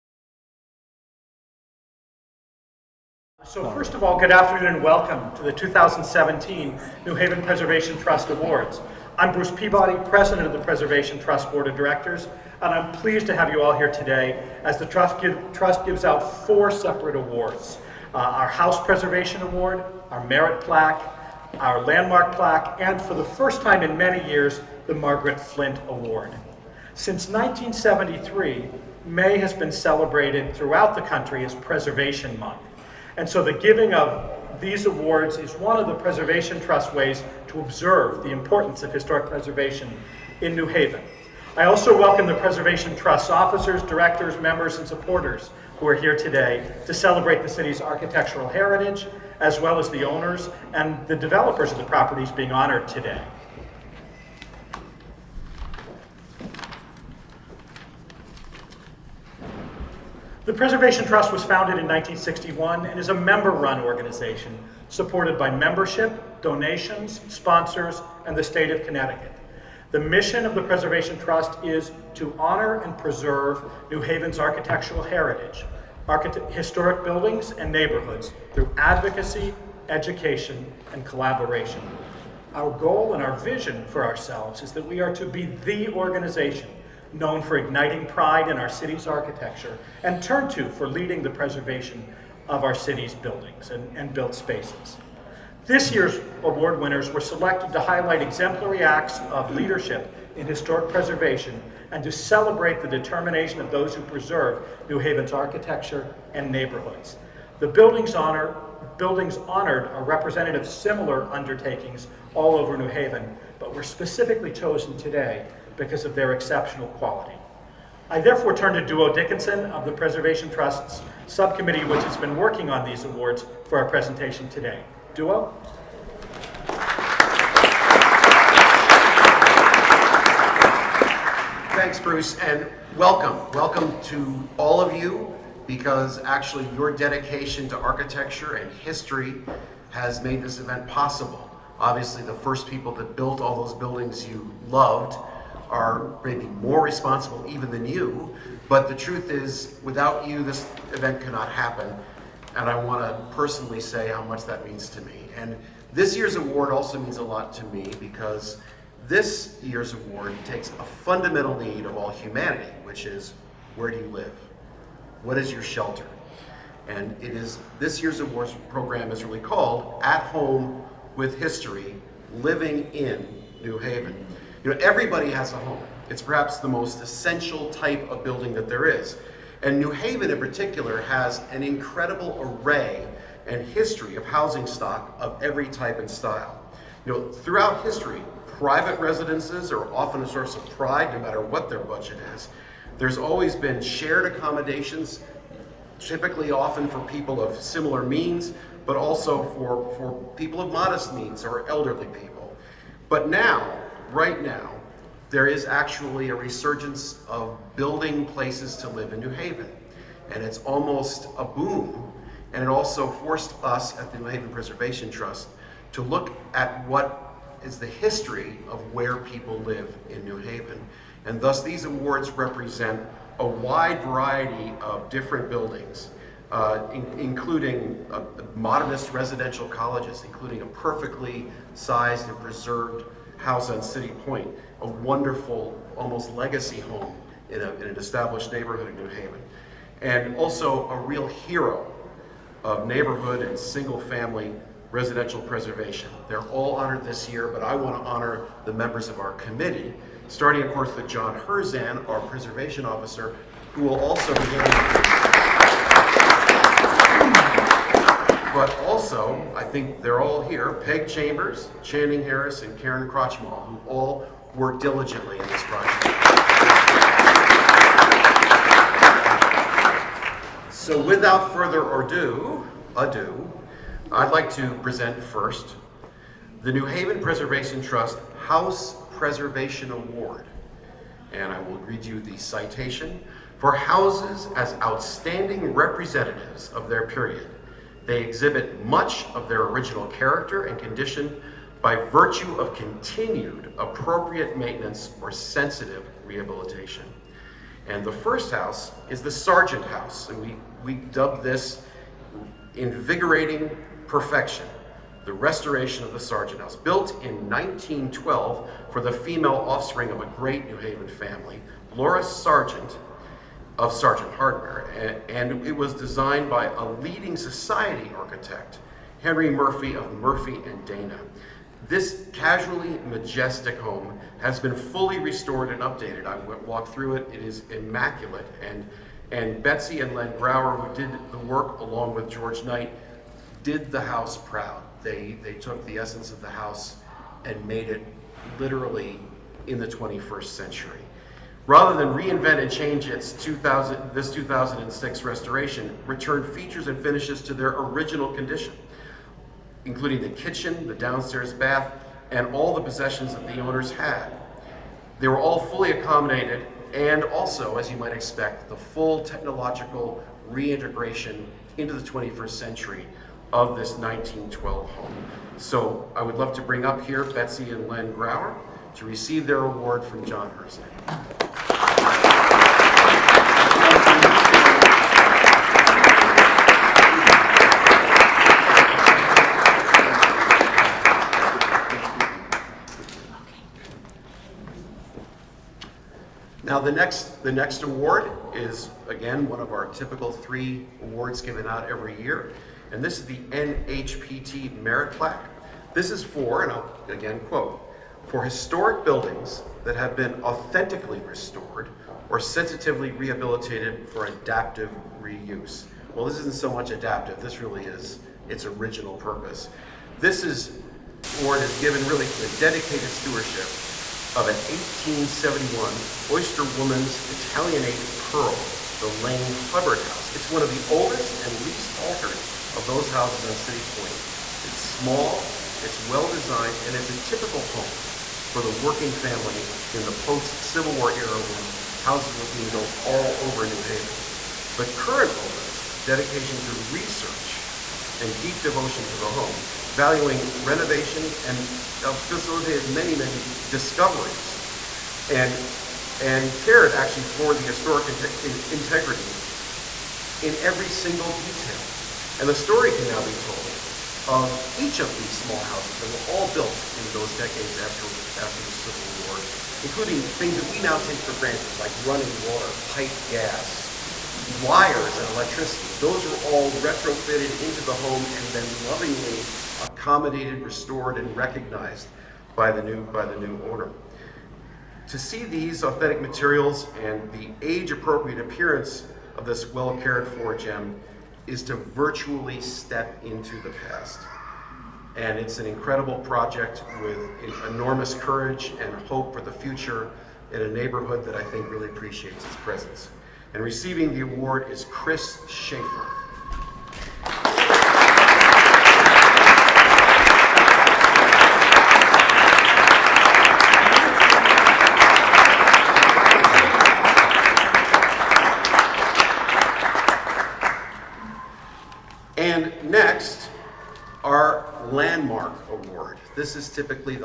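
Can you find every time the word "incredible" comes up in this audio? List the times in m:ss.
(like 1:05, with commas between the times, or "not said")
3:01, 8:05.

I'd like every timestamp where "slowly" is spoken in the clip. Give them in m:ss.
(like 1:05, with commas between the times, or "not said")
not said.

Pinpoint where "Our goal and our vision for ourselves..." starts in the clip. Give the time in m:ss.
1:22.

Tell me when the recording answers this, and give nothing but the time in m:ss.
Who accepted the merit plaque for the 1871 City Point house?
8:14.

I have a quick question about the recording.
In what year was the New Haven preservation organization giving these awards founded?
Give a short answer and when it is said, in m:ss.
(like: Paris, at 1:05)
1961, at 1:01.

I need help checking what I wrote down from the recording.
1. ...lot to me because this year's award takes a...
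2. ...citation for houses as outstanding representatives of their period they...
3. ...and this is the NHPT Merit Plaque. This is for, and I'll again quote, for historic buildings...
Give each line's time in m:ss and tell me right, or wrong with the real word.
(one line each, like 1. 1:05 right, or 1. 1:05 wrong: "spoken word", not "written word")
1. 2:37 right
2. 4:42 right
3. 6:32 right.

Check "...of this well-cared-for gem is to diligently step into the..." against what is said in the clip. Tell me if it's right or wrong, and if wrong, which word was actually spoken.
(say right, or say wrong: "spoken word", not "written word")
wrong: "virtually", not "diligently".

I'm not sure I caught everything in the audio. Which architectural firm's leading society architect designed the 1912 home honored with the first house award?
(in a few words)
Murphy and Dana.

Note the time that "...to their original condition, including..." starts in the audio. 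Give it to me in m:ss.
5:47.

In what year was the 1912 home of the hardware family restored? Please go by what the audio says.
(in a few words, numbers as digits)
2006.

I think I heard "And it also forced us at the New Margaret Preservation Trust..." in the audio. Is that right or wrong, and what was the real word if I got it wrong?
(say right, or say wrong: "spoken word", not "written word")
wrong: "Haven", not "Margaret".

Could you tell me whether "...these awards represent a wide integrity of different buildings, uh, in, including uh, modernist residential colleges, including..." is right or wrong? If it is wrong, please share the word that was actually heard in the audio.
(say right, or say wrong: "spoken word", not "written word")
wrong: "variety", not "integrity".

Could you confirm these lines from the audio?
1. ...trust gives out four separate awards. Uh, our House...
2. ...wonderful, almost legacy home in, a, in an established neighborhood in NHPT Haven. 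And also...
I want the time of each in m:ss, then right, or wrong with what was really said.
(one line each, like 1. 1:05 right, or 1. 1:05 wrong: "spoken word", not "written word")
1. 0:15 right
2. 3:54 wrong: "New", not "NHPT".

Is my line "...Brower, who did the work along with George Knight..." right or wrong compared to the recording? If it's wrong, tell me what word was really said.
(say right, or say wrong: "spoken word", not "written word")
right.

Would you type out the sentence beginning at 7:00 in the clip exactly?
It's one of the oldest and least altered of those houses on City Point.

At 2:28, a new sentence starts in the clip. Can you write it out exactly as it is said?
But the truth is, without you, this event cannot happen.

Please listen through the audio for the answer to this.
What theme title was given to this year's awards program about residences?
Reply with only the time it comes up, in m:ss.
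2:50.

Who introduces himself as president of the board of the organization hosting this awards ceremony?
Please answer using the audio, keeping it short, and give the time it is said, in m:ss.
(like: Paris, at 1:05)
Bruce Peabody, at 0:09.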